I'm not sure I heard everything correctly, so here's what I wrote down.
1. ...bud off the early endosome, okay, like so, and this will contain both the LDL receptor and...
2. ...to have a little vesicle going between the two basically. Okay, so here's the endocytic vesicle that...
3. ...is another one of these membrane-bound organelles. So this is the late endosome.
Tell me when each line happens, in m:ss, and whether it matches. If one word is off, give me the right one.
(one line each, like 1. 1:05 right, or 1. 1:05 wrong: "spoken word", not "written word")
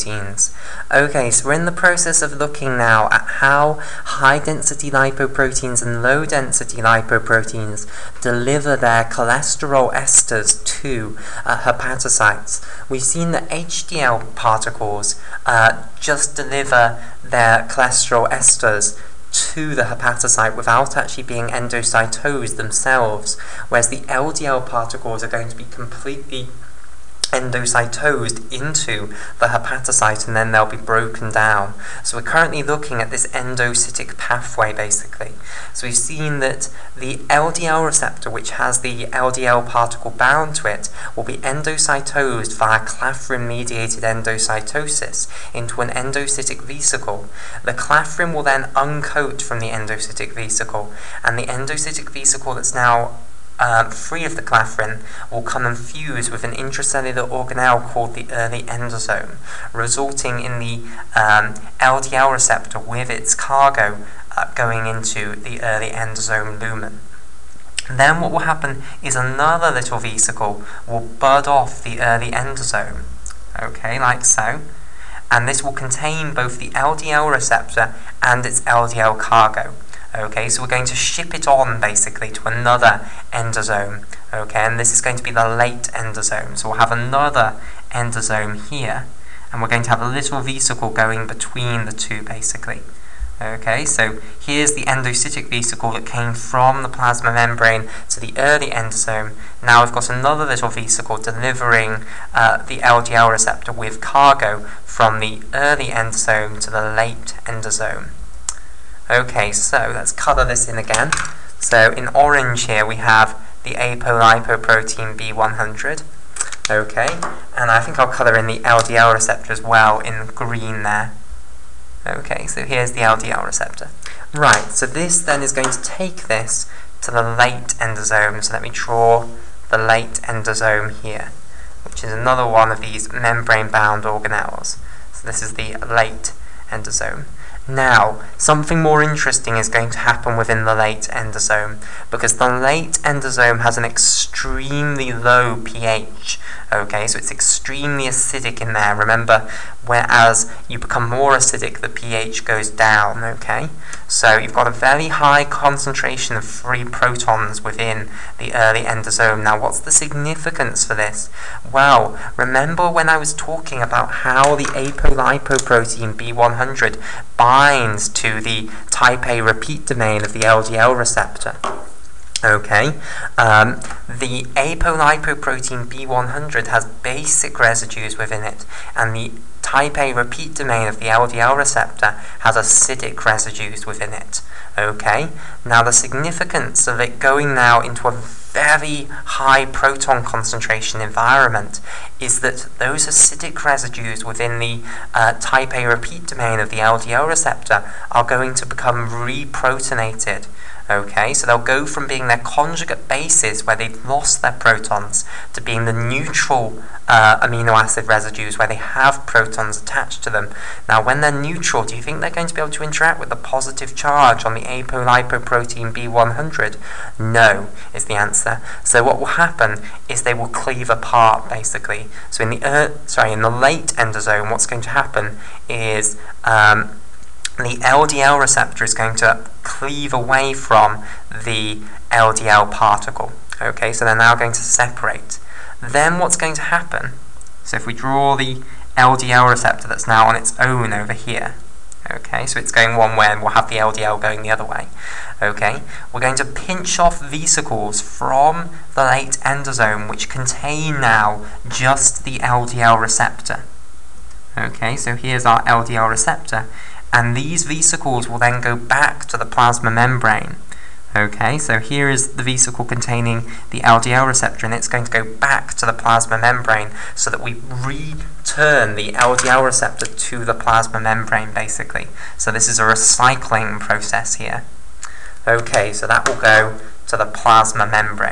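1. 1:11 right
2. 1:29 right
3. 2:12 right.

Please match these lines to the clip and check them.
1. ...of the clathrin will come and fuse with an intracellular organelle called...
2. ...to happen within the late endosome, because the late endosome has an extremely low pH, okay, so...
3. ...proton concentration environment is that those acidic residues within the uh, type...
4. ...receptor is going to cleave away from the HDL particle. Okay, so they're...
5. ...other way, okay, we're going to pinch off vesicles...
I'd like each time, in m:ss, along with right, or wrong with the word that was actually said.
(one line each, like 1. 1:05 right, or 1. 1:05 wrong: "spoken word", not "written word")
1. 0:54 right
2. 2:19 right
3. 3:09 right
4. 3:48 wrong: "LDL", not "HDL"
5. 4:04 right.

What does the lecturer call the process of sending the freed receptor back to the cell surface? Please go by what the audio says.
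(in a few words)
Recycling process.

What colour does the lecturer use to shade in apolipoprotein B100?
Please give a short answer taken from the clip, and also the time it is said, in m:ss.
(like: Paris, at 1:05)
Orange, at 1:52.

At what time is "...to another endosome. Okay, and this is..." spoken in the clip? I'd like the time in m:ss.
1:22.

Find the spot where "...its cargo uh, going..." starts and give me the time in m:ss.
1:03.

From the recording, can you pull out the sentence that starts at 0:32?
So we're currently looking at this endocytic pathway basically.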